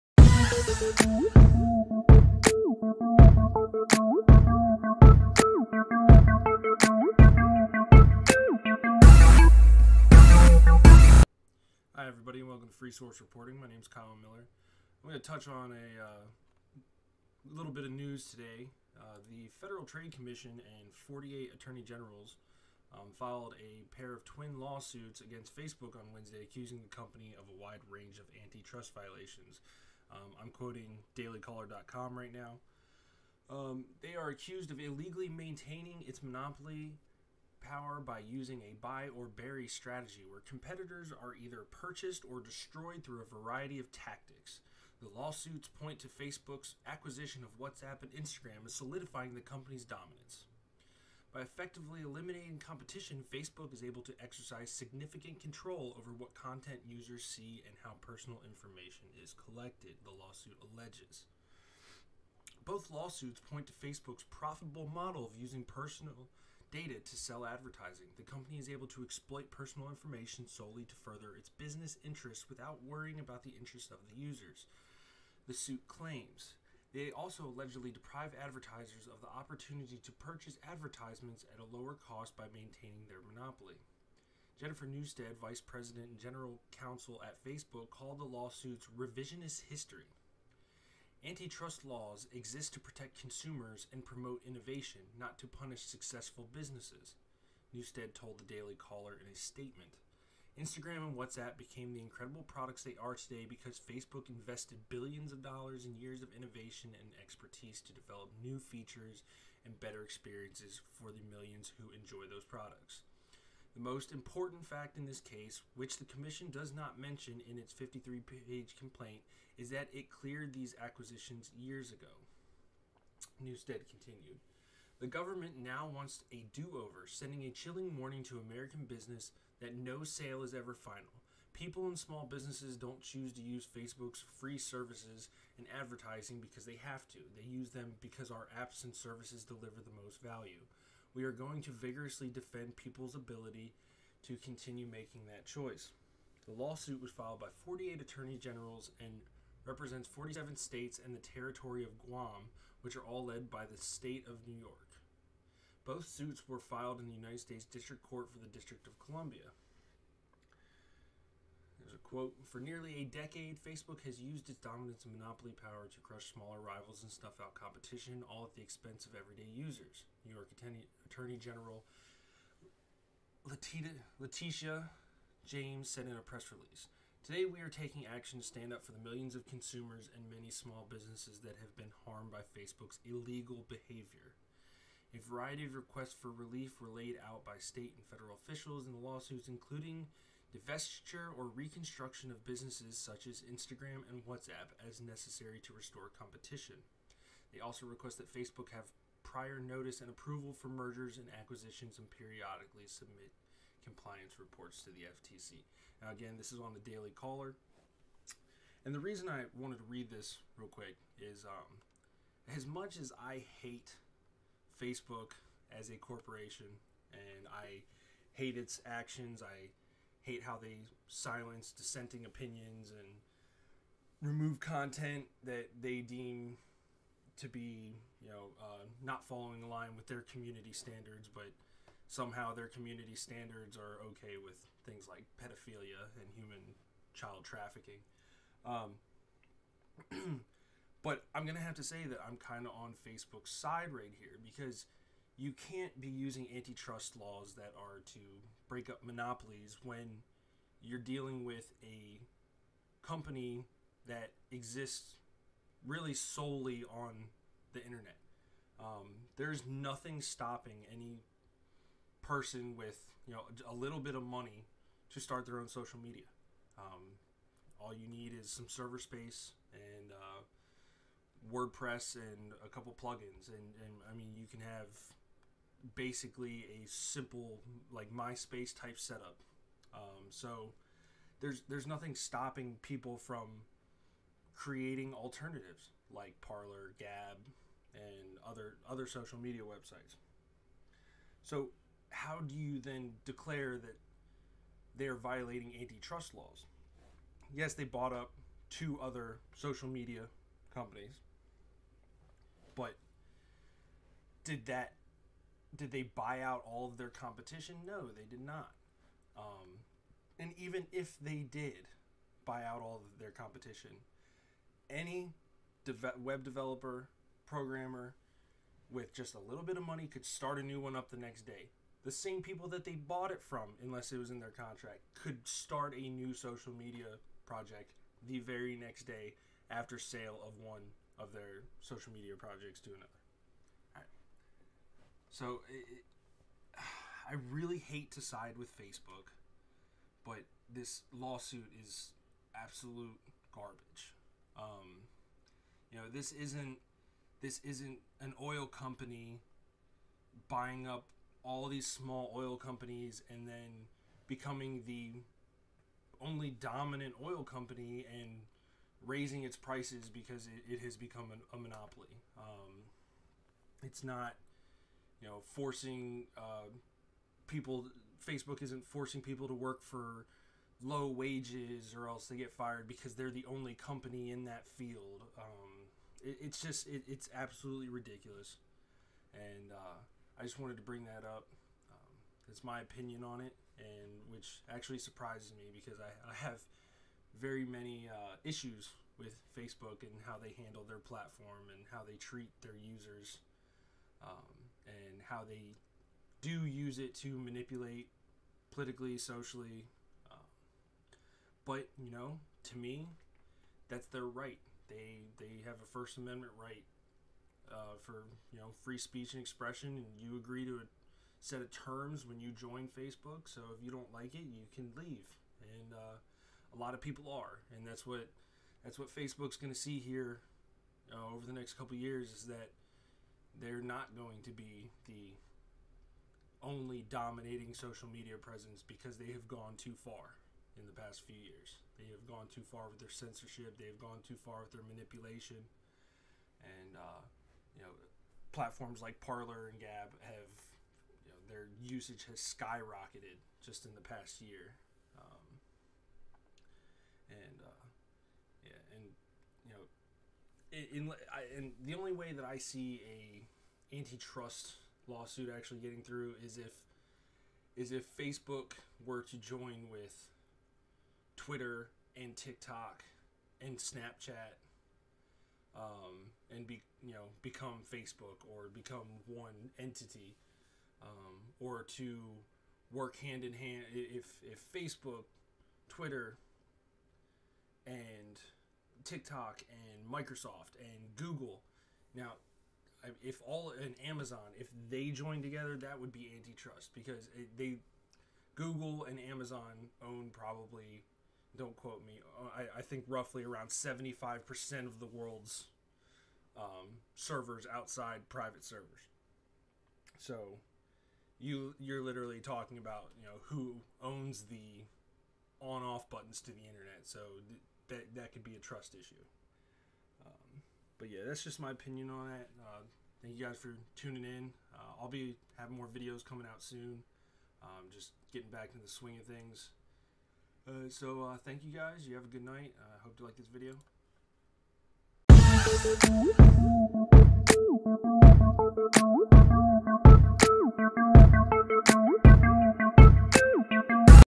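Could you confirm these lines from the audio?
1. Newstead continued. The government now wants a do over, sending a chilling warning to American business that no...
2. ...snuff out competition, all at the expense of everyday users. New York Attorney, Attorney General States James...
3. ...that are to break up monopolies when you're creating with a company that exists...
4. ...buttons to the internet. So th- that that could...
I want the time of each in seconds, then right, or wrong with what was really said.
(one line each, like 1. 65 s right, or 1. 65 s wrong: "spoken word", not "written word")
1. 123 s right
2. 167 s wrong: "Letitia", not "States"
3. 247 s wrong: "dealing", not "creating"
4. 506 s right.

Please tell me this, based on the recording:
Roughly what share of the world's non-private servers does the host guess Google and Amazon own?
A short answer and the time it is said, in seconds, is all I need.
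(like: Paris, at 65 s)
75%, at 493 s.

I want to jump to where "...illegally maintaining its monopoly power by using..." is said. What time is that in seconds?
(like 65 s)
34 s.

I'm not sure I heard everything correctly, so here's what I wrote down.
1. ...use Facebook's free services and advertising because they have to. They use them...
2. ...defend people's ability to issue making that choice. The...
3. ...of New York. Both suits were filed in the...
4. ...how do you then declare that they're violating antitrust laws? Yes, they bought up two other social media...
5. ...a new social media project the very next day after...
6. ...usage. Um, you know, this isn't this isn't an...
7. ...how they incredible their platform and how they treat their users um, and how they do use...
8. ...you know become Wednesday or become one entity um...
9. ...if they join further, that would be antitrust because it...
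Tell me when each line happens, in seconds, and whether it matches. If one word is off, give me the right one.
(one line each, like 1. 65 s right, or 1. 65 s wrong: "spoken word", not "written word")
1. 133 s right
2. 142 s wrong: "continue", not "issue"
3. 154 s right
4. 292 s right
5. 325 s right
6. 343 s wrong: "garbage", not "usage"
7. 390 s wrong: "handle", not "incredible"
8. 467 s wrong: "Facebook", not "Wednesday"
9. 484 s wrong: "together", not "further".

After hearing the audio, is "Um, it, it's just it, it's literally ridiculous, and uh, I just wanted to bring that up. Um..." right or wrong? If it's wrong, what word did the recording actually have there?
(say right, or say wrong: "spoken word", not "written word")
wrong: "absolutely", not "literally".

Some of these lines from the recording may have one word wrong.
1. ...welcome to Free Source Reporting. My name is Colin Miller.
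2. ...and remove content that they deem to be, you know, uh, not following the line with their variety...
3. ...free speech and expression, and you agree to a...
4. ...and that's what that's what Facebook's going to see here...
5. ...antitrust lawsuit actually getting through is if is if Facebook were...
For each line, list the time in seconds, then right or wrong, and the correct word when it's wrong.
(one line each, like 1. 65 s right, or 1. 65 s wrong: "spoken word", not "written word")
1. 12 s right
2. 222 s wrong: "community", not "variety"
3. 408 s right
4. 417 s right
5. 453 s right.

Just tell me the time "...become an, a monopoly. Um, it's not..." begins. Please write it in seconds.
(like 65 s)
360 s.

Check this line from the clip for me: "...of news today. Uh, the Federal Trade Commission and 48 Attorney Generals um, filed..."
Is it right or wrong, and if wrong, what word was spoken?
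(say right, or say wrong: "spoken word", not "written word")
right.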